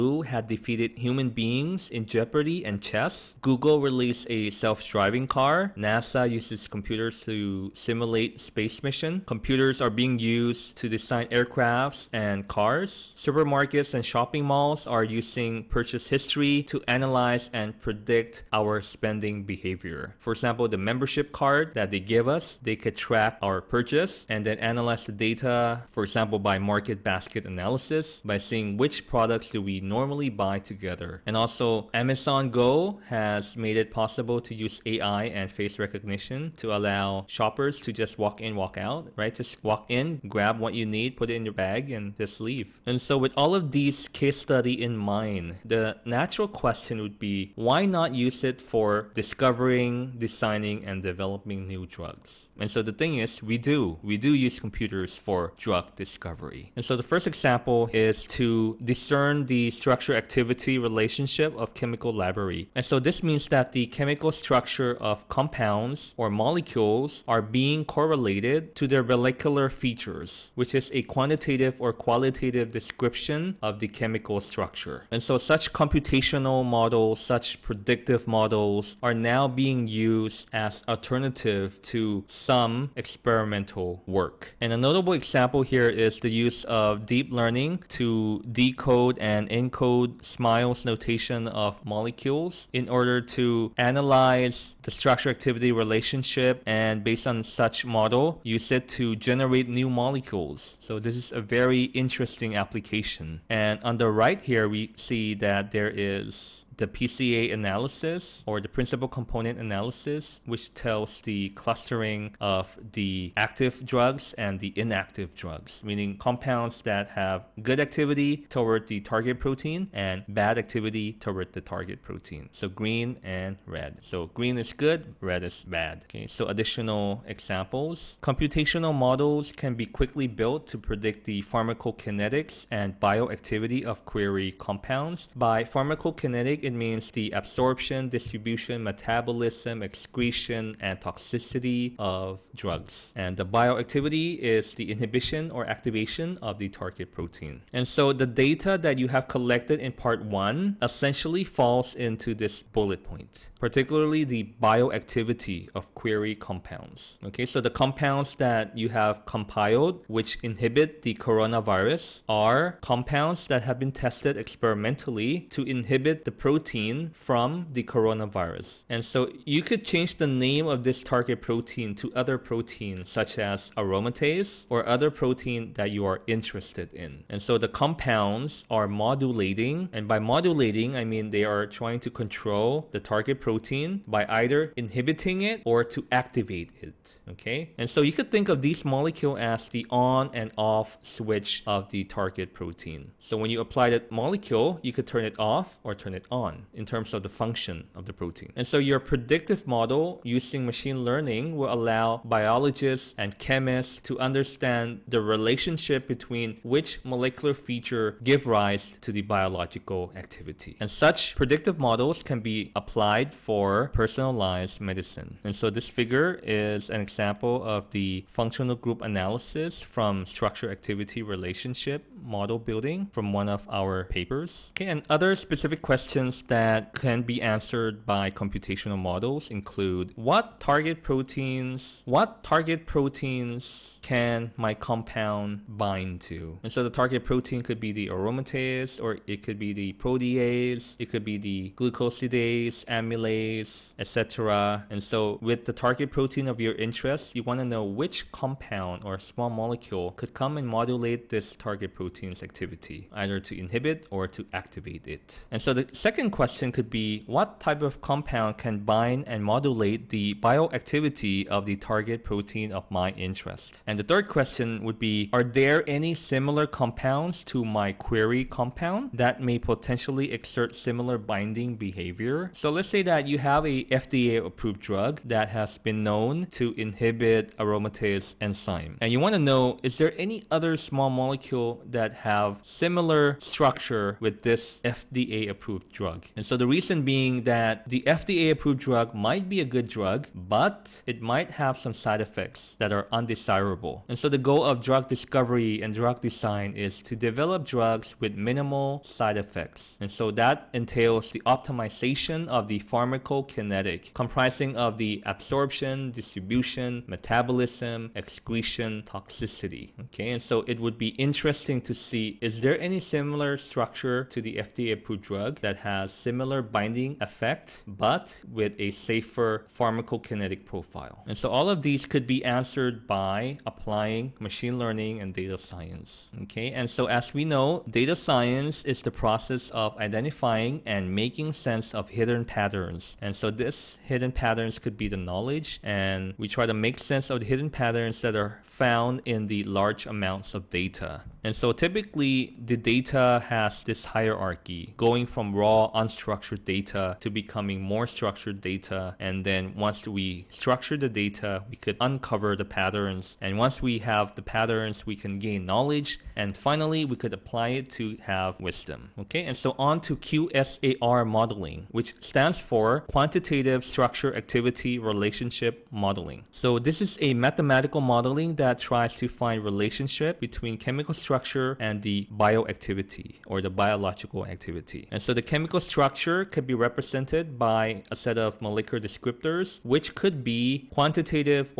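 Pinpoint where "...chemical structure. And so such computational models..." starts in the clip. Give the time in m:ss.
1:13.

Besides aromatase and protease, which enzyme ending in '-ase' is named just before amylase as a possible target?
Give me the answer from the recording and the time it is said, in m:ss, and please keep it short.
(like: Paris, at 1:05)
Glucosidase, at 4:01.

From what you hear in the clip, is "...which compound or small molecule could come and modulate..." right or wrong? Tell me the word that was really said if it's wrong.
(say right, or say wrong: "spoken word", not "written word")
right.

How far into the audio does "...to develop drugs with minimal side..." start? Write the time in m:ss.
4:57.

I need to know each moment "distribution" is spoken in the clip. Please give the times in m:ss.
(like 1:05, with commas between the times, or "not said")
2:18, 5:06.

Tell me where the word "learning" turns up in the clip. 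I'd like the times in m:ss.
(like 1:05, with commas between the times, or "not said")
1:27, 3:21, 5:24.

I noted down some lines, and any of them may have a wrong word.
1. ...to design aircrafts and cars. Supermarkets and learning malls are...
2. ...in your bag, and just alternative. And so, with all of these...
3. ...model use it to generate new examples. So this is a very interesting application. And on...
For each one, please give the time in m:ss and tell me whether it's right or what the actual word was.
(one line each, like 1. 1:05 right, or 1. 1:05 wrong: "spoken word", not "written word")
1. 0:10 wrong: "shopping", not "learning"
2. 0:41 wrong: "leave", not "alternative"
3. 1:37 wrong: "molecules", not "examples".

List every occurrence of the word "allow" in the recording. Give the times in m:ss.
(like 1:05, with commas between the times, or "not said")
0:36, 3:21.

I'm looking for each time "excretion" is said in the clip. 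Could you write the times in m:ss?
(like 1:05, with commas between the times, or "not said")
2:19, 5:08.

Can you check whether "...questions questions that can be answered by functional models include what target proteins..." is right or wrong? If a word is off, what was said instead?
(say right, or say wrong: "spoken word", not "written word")
wrong: "computational", not "functional".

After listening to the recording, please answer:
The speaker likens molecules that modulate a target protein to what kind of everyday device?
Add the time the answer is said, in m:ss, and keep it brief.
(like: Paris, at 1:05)
On and off switch, at 3:09.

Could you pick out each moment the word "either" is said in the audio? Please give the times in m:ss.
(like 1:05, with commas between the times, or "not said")
3:04, 4:13.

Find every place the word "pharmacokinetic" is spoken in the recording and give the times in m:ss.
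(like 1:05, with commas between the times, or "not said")
2:11, 2:15, 5:02, 5:19.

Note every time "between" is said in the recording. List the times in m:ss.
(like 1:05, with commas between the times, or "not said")
3:26, 6:10.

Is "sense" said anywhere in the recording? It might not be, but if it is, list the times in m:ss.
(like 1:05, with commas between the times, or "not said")
5:31, 5:36.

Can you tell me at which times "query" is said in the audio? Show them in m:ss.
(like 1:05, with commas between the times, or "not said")
2:14, 2:35, 4:27.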